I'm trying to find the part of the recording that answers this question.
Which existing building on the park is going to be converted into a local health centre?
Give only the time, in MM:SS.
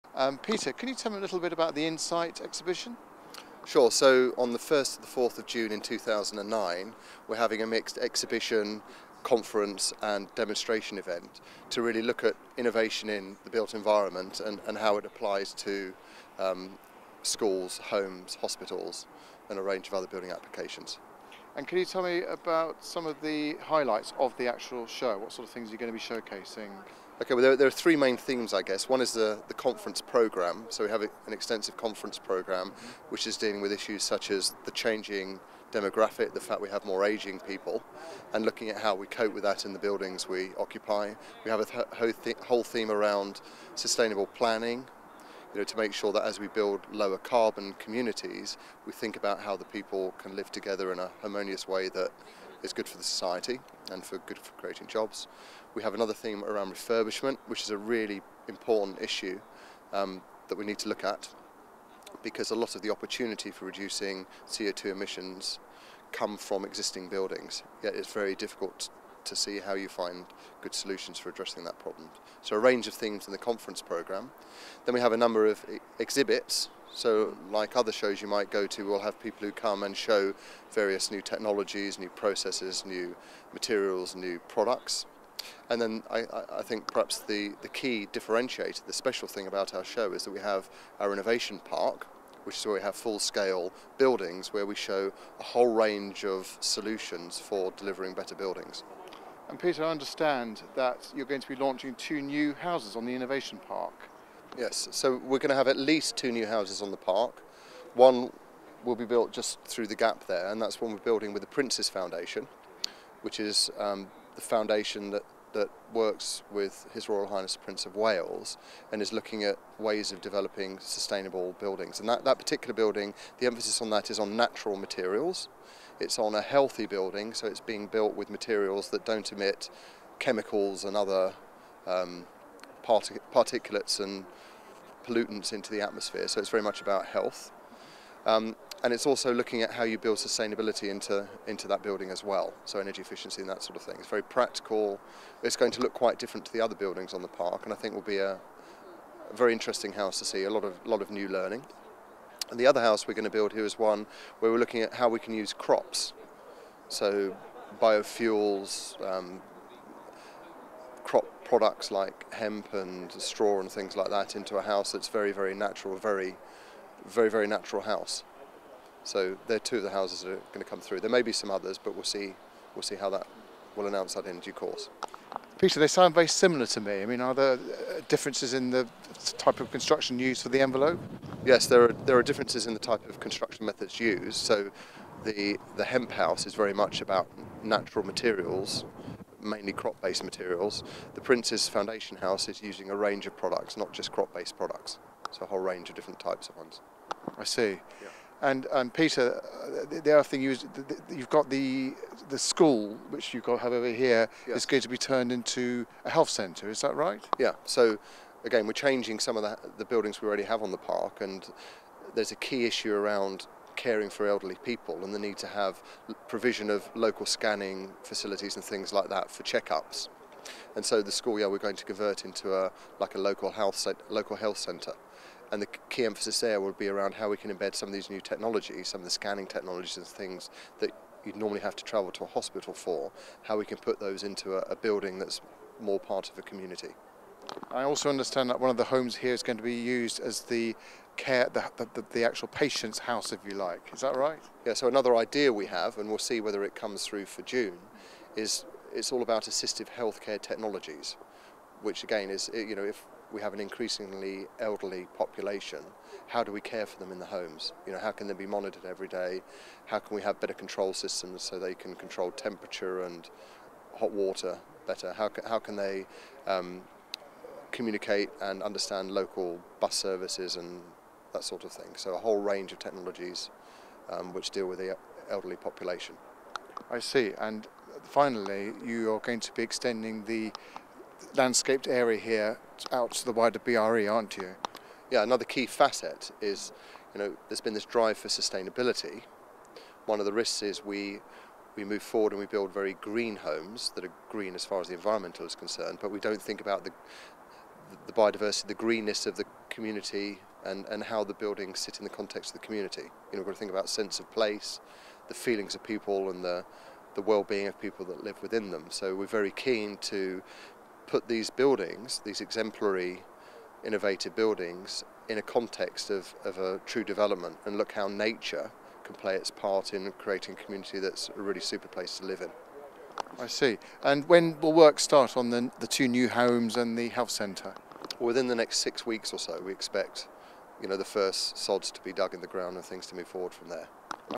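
03:41.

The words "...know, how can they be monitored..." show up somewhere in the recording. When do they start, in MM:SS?
04:17.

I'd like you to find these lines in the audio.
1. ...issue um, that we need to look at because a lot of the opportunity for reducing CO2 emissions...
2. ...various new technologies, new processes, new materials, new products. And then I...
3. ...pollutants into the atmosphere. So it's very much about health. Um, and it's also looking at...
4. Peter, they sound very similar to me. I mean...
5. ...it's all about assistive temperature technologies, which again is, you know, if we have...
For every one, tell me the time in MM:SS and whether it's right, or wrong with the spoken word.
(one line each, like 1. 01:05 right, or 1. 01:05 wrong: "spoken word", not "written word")
1. 00:59 right
2. 01:20 right
3. 02:15 right
4. 02:55 right
5. 04:08 wrong: "healthcare", not "temperature".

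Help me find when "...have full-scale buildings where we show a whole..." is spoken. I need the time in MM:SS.
01:32.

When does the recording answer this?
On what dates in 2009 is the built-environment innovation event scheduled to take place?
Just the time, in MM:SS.
00:04.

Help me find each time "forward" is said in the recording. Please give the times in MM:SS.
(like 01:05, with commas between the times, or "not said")
04:52, 05:33.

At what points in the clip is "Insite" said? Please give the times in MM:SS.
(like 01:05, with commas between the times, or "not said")
00:01.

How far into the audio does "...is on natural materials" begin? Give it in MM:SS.
02:04.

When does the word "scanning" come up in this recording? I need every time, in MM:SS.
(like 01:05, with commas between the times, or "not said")
03:37, 03:49.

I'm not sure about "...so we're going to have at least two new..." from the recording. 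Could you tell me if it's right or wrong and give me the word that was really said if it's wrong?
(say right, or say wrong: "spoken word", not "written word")
right.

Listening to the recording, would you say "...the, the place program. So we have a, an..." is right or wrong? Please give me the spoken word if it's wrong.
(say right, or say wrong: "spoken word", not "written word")
wrong: "conference", not "place".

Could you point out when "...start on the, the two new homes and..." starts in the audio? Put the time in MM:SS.
05:24.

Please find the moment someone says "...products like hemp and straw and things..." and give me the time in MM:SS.
02:41.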